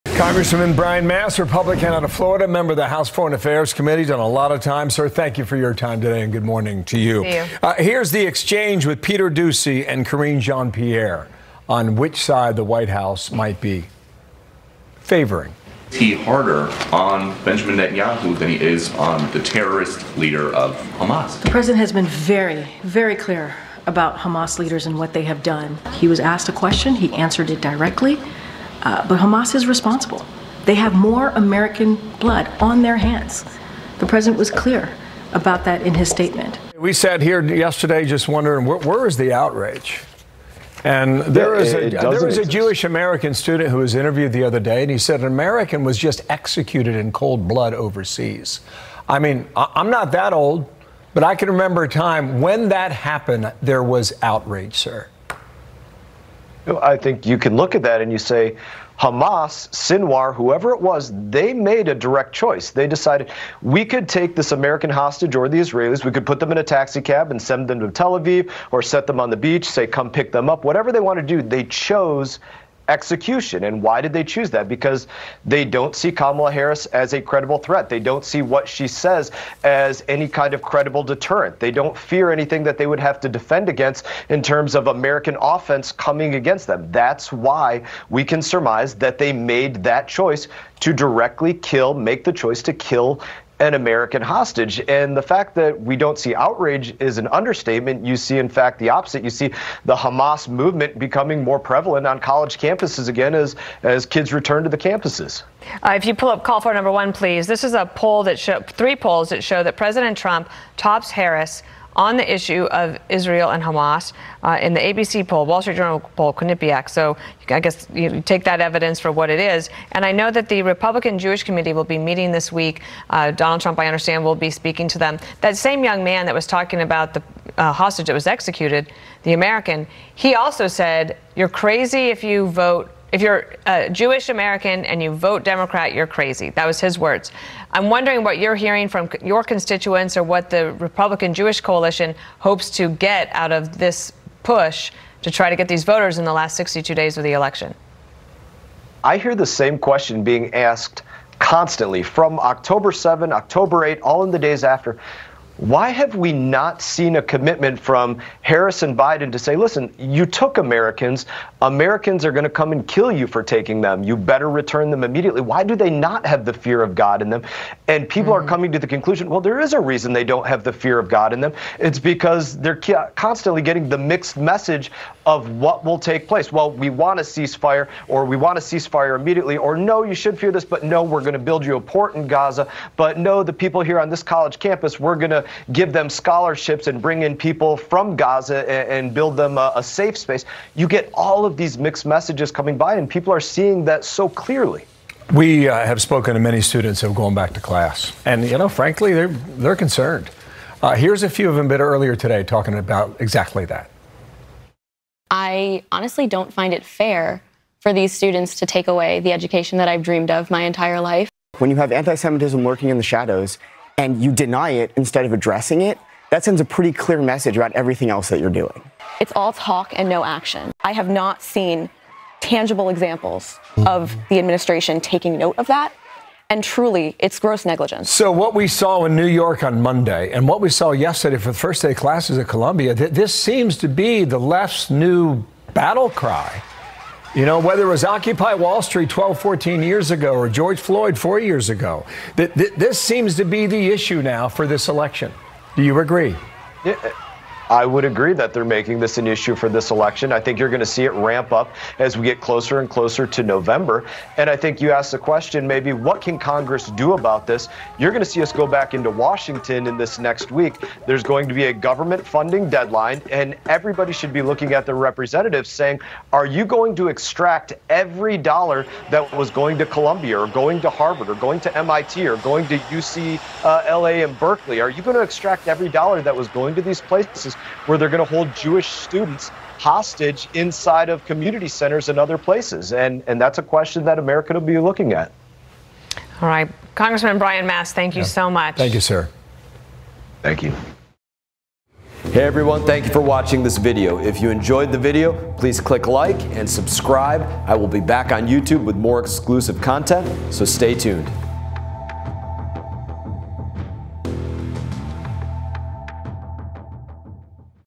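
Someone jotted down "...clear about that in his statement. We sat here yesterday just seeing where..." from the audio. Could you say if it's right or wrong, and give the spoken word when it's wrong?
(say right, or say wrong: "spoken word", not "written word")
wrong: "wondering", not "seeing".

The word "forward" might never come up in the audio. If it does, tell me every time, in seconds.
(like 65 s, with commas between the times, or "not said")
not said.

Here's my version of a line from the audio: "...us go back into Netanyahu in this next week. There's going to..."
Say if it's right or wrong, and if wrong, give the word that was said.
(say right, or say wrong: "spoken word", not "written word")
wrong: "Washington", not "Netanyahu".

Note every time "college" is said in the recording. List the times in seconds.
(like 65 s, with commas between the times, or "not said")
102 s, 184 s.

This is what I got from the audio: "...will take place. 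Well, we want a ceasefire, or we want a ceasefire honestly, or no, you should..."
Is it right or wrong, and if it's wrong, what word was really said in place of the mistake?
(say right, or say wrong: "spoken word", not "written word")
wrong: "immediately", not "honestly".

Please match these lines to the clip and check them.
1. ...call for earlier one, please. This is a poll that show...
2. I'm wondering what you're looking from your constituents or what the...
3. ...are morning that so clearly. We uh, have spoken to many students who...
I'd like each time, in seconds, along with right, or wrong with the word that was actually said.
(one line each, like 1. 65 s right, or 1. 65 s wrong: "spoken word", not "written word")
1. 106 s wrong: "number", not "earlier"
2. 137 s wrong: "hearing", not "looking"
3. 193 s wrong: "seeing", not "morning".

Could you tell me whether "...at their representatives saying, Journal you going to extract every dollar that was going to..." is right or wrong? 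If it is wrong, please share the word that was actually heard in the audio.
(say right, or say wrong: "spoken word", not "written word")
wrong: "Are", not "Journal".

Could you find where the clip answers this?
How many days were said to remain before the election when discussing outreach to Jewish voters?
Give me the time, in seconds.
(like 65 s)
146 s.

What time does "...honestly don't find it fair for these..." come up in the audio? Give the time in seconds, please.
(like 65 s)
205 s.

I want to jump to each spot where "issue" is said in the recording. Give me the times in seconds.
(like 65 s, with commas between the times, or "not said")
112 s, 243 s, 249 s.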